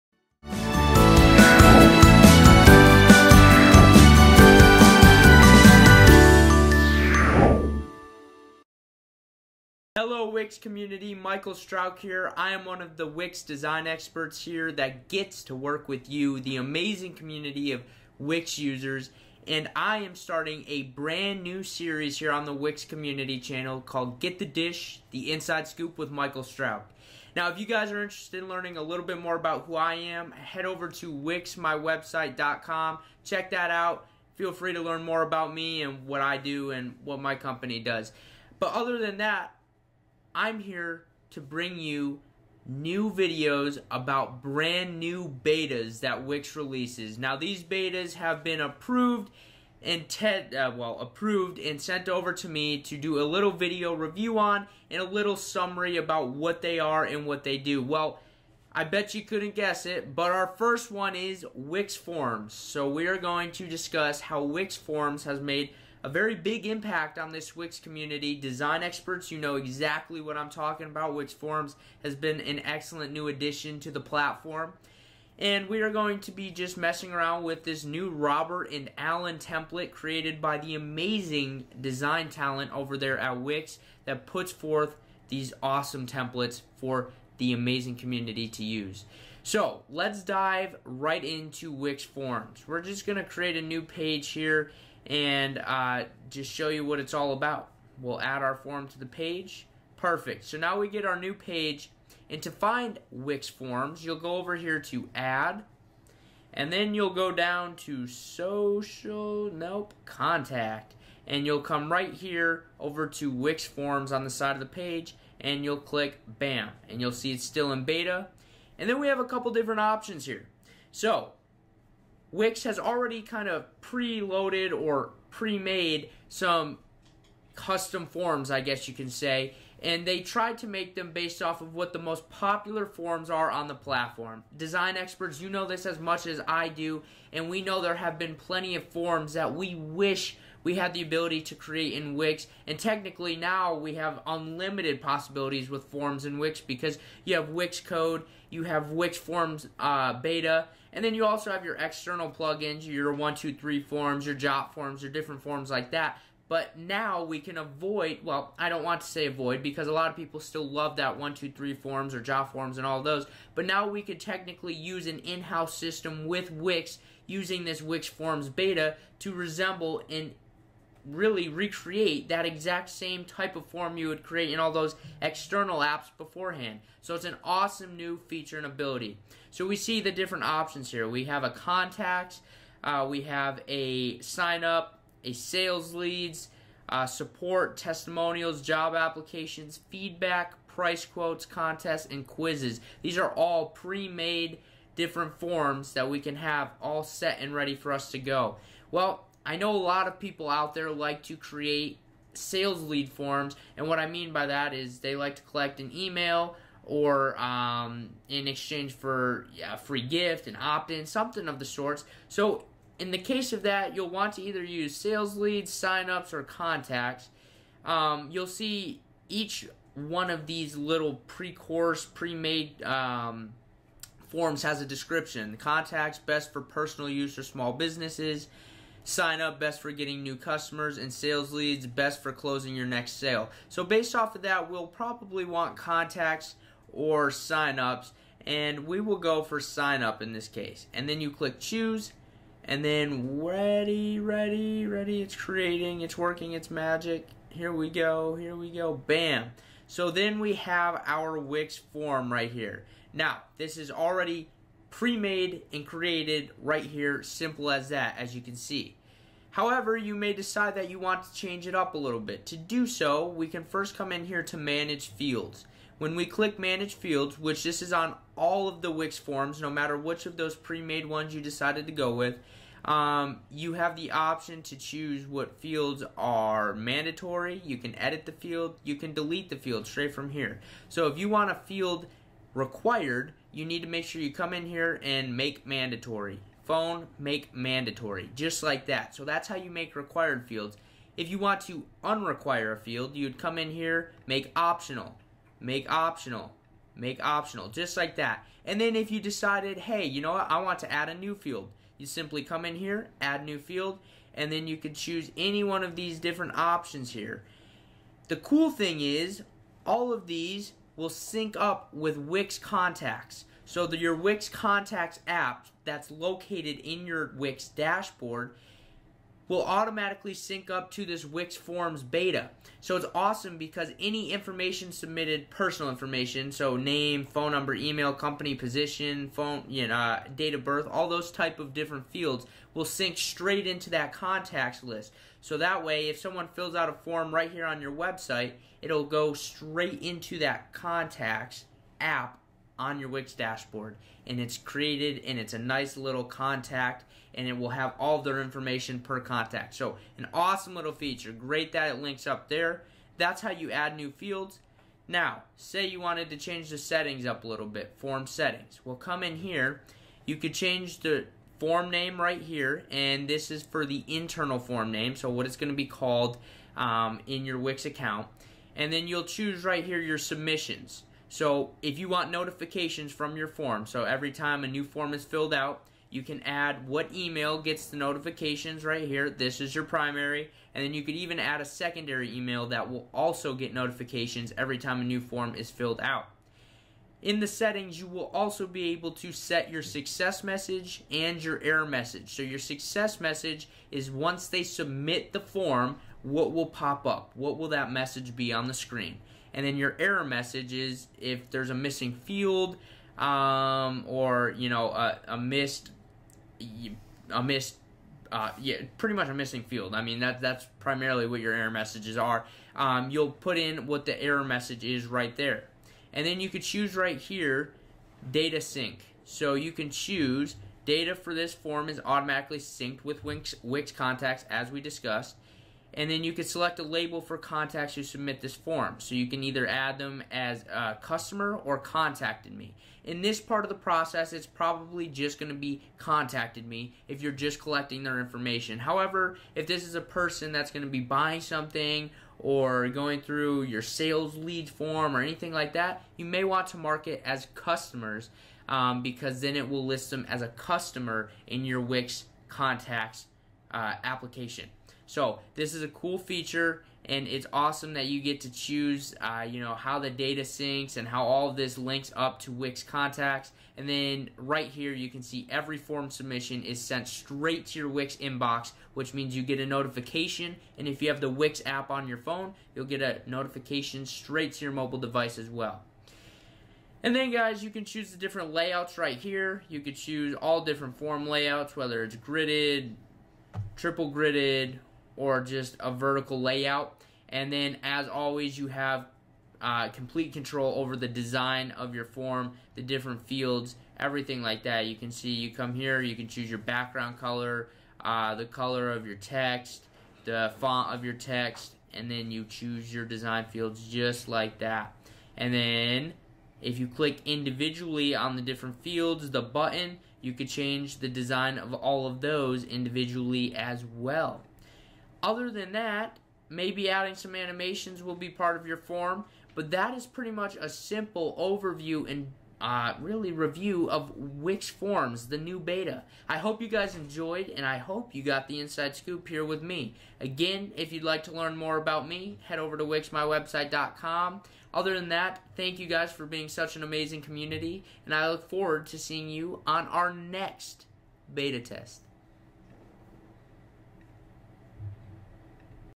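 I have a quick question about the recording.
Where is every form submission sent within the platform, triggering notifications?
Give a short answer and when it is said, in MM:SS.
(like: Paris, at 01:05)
Wix inbox, at 07:47.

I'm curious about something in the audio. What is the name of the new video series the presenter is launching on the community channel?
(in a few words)
Get the Dish.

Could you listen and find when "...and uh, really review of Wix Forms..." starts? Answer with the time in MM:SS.
08:42.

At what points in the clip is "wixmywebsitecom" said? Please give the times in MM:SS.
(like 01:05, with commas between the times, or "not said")
00:31, 08:52.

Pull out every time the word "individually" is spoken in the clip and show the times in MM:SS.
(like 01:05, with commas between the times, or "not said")
08:27, 08:32.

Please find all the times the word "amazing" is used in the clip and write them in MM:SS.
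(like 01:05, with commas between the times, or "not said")
00:16, 01:20, 01:27, 08:56.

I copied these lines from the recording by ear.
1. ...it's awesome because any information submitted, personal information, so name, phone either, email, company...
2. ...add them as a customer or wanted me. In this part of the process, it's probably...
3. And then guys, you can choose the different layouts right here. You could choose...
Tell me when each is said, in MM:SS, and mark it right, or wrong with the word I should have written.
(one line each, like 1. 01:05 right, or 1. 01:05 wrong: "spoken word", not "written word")
1. 05:22 wrong: "number", not "either"
2. 07:09 wrong: "contacted", not "wanted"
3. 07:57 right.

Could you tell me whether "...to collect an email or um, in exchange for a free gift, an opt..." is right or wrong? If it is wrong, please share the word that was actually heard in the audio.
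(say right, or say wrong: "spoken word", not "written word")
right.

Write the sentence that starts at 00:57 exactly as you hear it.
Well, I bet you couldn't guess it, but our first one is Wix Forms.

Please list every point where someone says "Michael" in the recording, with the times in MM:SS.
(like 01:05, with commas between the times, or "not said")
00:11, 00:26.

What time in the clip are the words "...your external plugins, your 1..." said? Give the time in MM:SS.
02:31.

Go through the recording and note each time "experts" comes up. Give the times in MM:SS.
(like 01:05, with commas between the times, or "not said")
00:13, 01:08, 02:14.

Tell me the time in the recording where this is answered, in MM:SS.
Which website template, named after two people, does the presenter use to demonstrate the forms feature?
01:18.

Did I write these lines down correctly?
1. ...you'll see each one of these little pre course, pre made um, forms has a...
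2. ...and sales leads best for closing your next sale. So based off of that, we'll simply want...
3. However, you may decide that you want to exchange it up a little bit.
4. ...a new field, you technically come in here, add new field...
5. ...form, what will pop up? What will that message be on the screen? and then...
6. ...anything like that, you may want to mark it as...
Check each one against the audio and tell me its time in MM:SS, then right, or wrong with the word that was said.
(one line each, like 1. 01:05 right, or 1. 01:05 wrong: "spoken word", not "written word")
1. 03:38 right
2. 03:50 wrong: "probably", not "simply"
3. 04:19 wrong: "change", not "exchange"
4. 05:01 wrong: "simply", not "technically"
5. 06:35 right
6. 07:25 right.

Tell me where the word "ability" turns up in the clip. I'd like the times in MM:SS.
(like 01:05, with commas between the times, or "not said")
02:21, 02:58.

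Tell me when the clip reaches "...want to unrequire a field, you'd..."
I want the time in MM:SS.
04:51.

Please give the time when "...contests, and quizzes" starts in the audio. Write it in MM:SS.
03:11.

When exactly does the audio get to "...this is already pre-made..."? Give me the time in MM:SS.
04:13.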